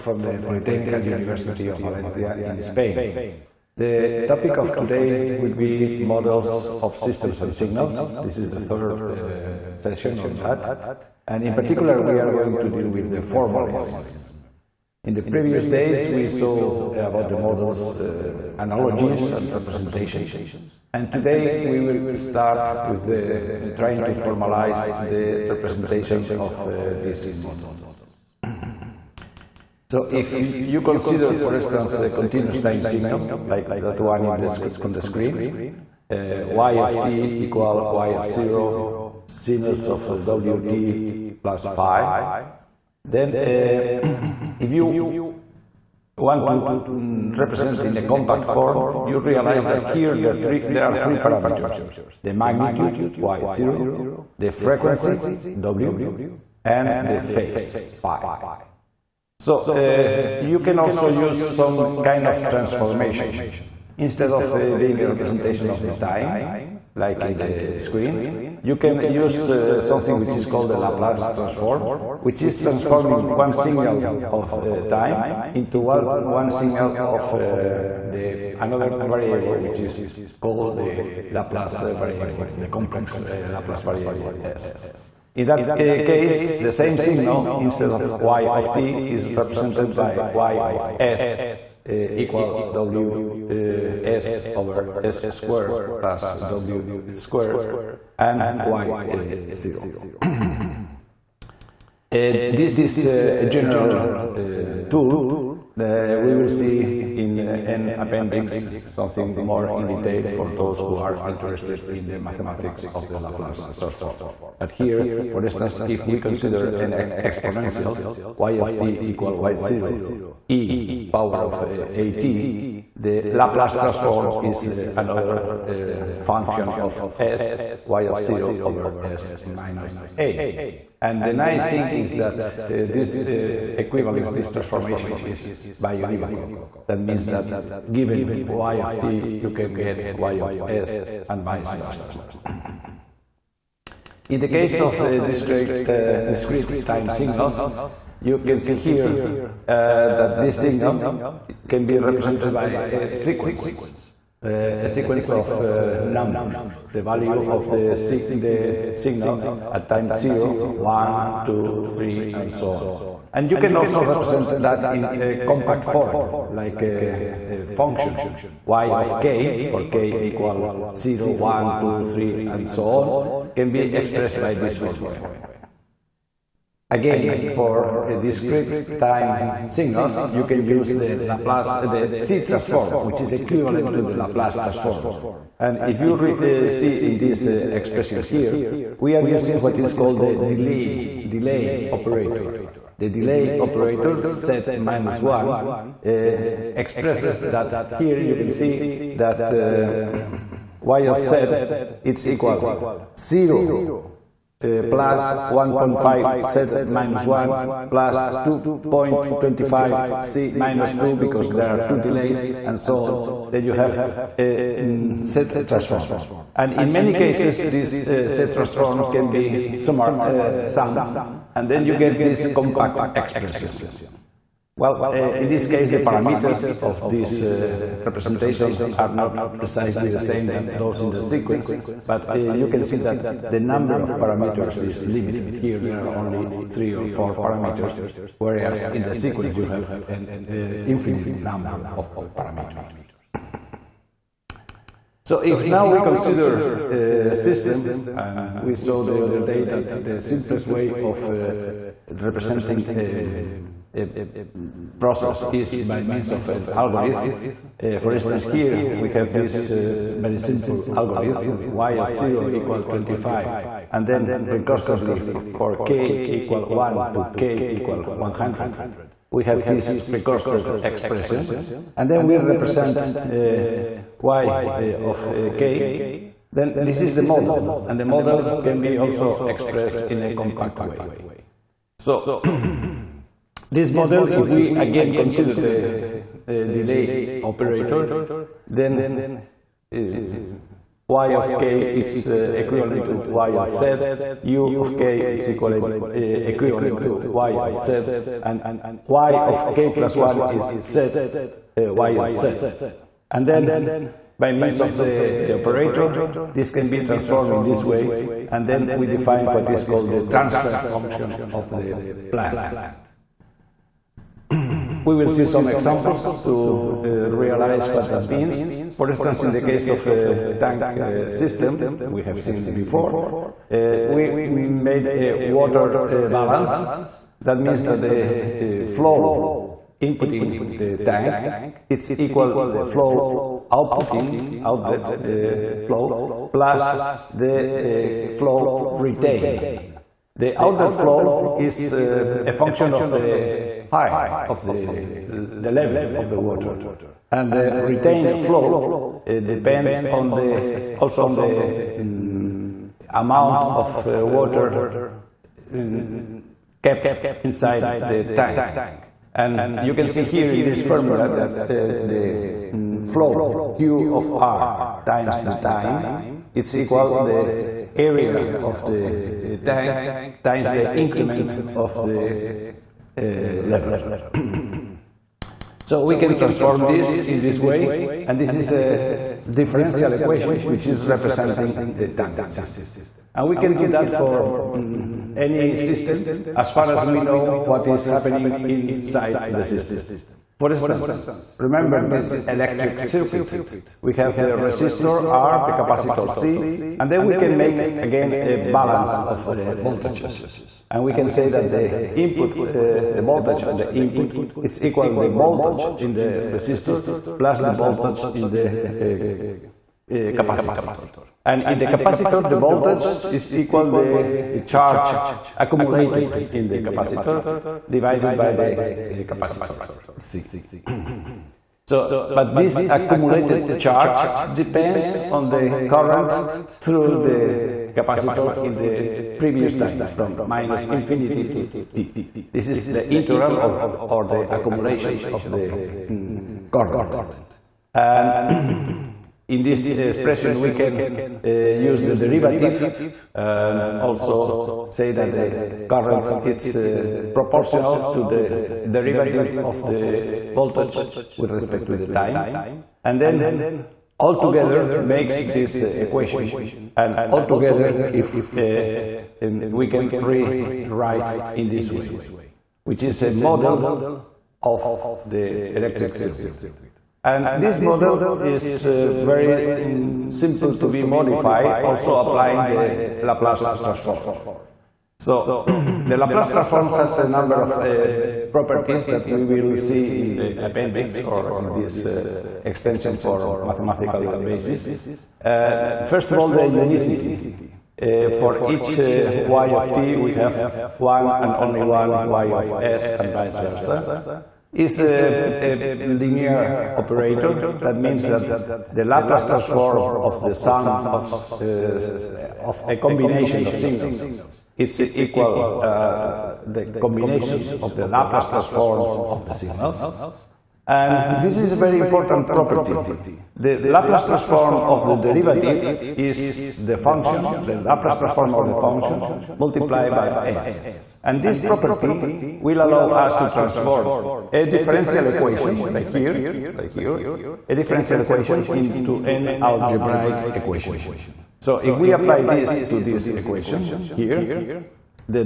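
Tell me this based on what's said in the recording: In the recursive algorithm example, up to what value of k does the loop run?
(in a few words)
100.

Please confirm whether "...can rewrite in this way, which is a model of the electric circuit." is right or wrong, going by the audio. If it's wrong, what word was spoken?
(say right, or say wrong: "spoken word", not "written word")
right.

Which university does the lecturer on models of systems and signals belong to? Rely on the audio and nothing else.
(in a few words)
Polytechnical University of Valencia.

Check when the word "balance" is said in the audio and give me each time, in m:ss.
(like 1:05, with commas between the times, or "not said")
5:26, 6:38.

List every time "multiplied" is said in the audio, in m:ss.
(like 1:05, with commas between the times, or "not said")
8:39.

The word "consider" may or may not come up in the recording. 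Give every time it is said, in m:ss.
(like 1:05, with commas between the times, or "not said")
0:30, 1:56, 4:06, 4:45.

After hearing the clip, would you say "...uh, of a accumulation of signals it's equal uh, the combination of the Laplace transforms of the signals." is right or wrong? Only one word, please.
wrong.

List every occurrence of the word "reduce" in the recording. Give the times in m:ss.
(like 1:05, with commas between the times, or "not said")
not said.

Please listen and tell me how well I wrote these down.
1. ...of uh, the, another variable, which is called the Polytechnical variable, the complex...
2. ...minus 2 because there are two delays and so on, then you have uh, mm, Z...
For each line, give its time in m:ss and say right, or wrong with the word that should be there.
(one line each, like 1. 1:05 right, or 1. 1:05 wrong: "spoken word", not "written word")
1. 1:17 wrong: "Laplace", not "Polytechnical"
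2. 3:30 right.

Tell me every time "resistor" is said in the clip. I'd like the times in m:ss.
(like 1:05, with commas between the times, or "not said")
6:34, 6:46.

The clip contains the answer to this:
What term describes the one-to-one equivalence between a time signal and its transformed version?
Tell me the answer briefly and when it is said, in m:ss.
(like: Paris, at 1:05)
biunivocal, at 2:15.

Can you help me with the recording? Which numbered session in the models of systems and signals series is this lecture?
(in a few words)
third.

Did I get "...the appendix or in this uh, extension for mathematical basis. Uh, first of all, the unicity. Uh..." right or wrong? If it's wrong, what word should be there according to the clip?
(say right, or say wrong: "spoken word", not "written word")
right.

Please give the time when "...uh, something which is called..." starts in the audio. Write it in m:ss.
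1:09.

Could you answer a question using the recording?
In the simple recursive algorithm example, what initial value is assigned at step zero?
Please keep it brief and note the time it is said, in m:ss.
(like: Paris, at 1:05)
25, at 4:22.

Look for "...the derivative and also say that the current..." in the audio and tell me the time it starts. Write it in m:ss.
7:22.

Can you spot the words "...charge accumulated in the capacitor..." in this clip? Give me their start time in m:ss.
6:54.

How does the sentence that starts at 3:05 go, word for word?
And if you re, uh, see in this uh, expression here, we are using what is called the delay, delay operator.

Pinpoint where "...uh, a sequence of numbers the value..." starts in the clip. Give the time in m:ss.
2:34.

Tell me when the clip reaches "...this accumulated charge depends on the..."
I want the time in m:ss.
7:02.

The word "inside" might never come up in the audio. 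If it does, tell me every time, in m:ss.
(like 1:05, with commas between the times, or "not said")
5:57, 6:28.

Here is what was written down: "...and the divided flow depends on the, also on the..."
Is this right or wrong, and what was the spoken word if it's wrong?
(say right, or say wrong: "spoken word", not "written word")
wrong: "retained", not "divided".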